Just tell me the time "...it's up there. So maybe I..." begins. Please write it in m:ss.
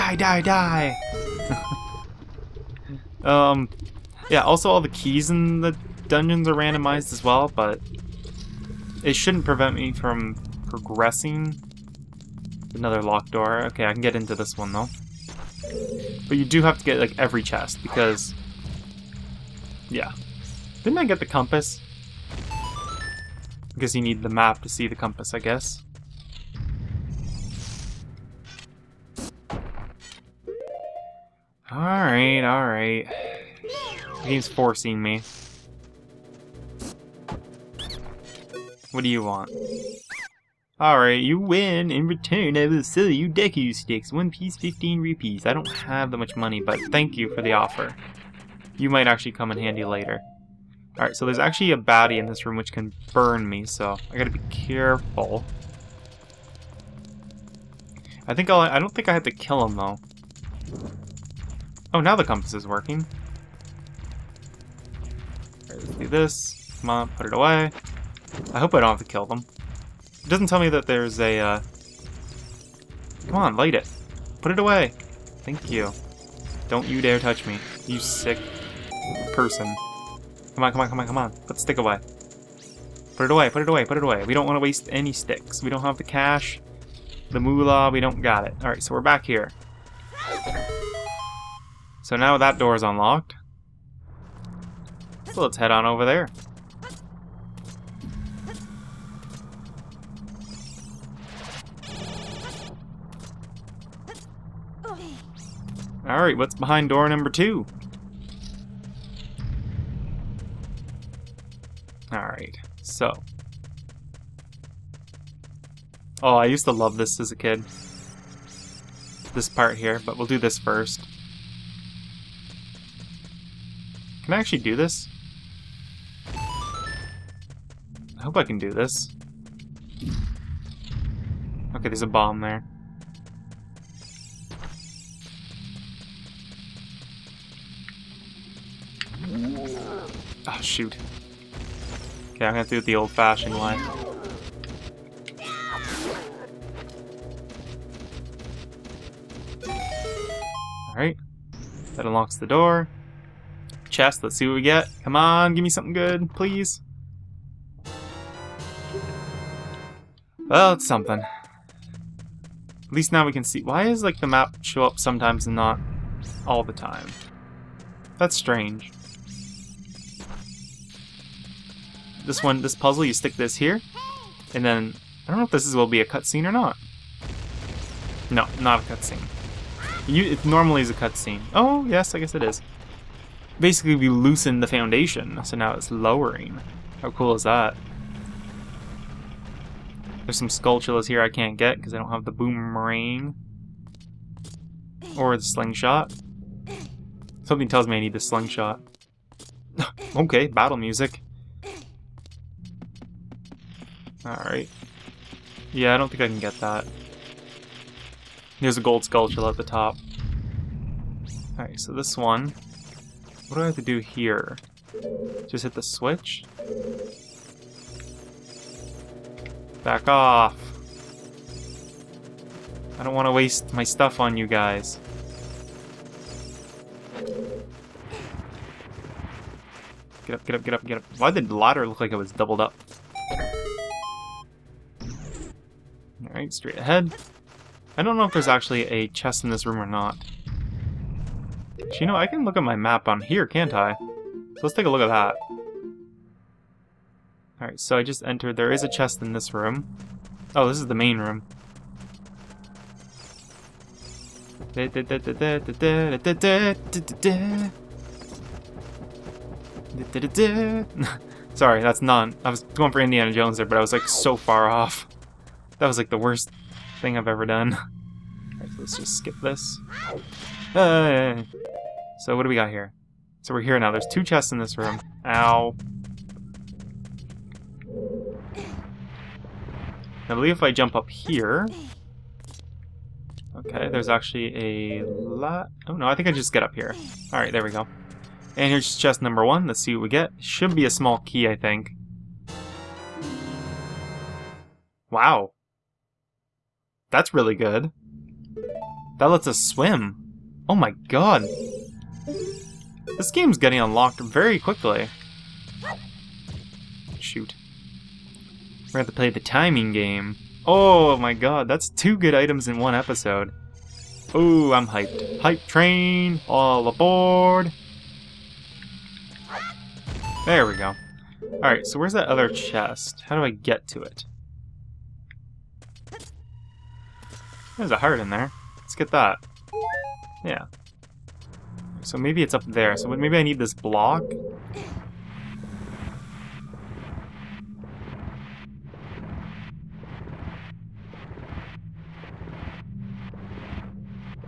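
5:32.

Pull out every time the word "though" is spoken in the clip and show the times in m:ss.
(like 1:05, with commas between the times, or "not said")
0:14, 0:59.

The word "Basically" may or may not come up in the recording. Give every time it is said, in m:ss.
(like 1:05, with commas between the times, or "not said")
3:03.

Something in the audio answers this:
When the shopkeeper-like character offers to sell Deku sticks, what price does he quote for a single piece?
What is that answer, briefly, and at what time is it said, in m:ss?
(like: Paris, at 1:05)
15 rupees, at 0:44.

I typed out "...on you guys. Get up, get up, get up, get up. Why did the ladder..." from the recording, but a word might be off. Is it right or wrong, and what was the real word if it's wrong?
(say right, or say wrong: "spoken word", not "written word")
right.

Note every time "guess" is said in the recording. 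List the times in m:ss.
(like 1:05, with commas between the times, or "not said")
0:25, 3:02.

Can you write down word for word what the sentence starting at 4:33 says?
There's two chests in this room.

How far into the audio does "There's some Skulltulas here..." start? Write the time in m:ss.
3:10.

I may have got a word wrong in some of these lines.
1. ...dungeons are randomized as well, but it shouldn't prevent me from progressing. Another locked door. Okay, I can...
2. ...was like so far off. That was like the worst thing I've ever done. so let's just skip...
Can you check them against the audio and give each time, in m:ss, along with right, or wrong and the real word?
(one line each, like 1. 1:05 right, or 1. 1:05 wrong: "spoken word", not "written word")
1. 0:06 right
2. 4:23 right.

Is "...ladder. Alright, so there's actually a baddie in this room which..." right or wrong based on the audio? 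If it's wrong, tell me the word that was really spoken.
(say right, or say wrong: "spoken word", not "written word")
wrong: "later", not "ladder".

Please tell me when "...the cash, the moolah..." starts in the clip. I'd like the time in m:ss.
1:25.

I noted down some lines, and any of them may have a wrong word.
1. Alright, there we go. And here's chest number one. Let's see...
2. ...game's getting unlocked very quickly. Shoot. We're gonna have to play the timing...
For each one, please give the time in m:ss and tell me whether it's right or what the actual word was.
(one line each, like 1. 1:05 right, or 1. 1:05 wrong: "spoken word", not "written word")
1. 4:47 right
2. 5:03 right.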